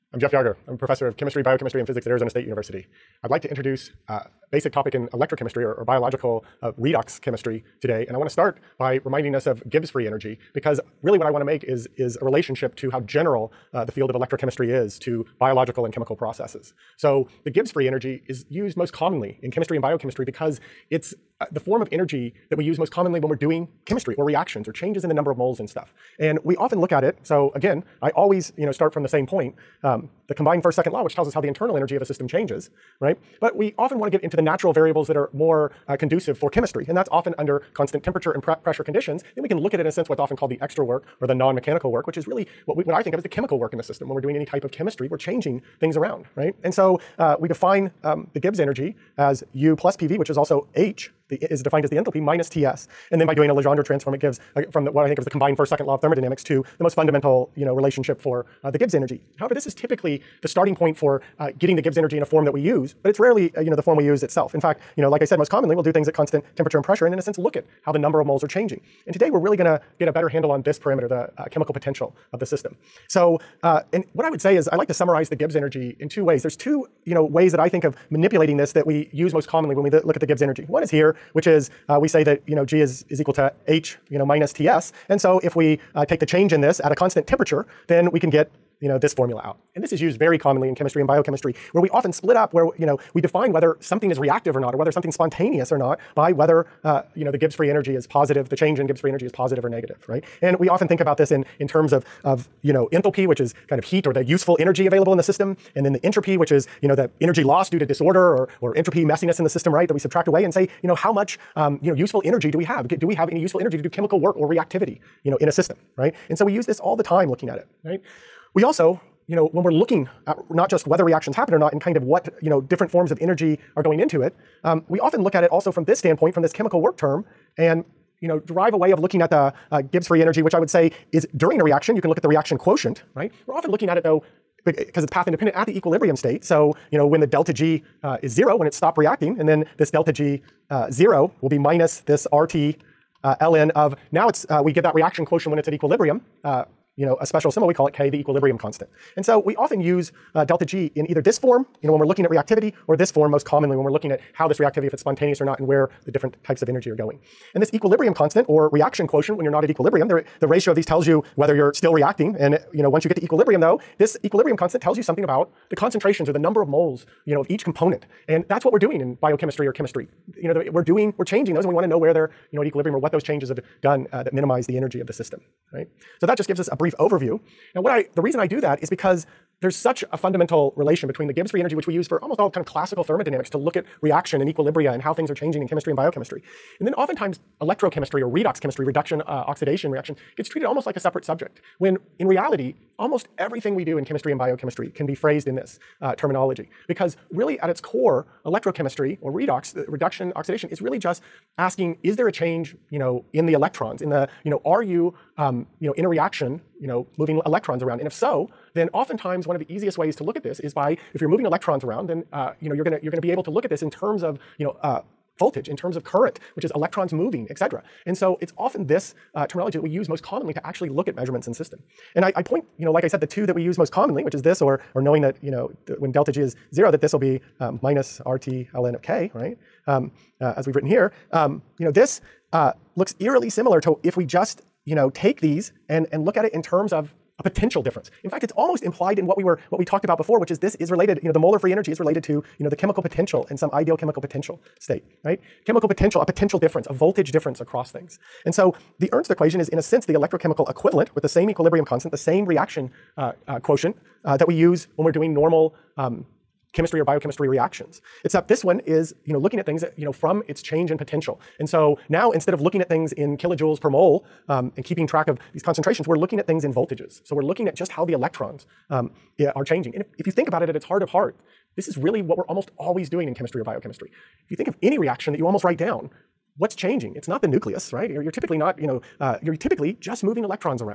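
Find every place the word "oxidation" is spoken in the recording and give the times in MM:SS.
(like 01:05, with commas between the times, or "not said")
03:09, 03:20.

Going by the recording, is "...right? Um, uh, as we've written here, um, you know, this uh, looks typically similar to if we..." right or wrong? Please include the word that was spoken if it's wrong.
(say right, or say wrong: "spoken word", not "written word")
wrong: "eerily", not "typically".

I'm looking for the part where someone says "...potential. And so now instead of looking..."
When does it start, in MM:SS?
04:20.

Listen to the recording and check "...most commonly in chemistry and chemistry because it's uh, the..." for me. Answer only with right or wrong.
wrong.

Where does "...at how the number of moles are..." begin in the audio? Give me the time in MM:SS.
01:07.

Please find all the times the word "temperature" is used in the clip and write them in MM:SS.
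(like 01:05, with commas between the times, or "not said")
00:38, 01:06, 01:27.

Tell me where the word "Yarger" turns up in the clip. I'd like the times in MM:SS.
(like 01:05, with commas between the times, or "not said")
00:00.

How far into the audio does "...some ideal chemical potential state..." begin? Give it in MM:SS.
04:03.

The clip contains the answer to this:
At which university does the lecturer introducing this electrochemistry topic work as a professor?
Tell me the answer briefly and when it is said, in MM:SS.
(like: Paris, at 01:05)
Arizona State University, at 00:02.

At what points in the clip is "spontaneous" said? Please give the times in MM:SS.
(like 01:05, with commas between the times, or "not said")
01:35, 02:35.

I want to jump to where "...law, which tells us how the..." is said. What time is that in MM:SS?
00:30.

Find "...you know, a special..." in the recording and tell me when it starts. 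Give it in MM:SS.
02:26.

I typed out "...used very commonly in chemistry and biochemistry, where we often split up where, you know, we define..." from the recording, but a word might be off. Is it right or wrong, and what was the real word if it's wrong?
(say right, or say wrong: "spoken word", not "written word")
right.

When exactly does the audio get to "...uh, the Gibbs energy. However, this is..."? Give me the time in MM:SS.
00:58.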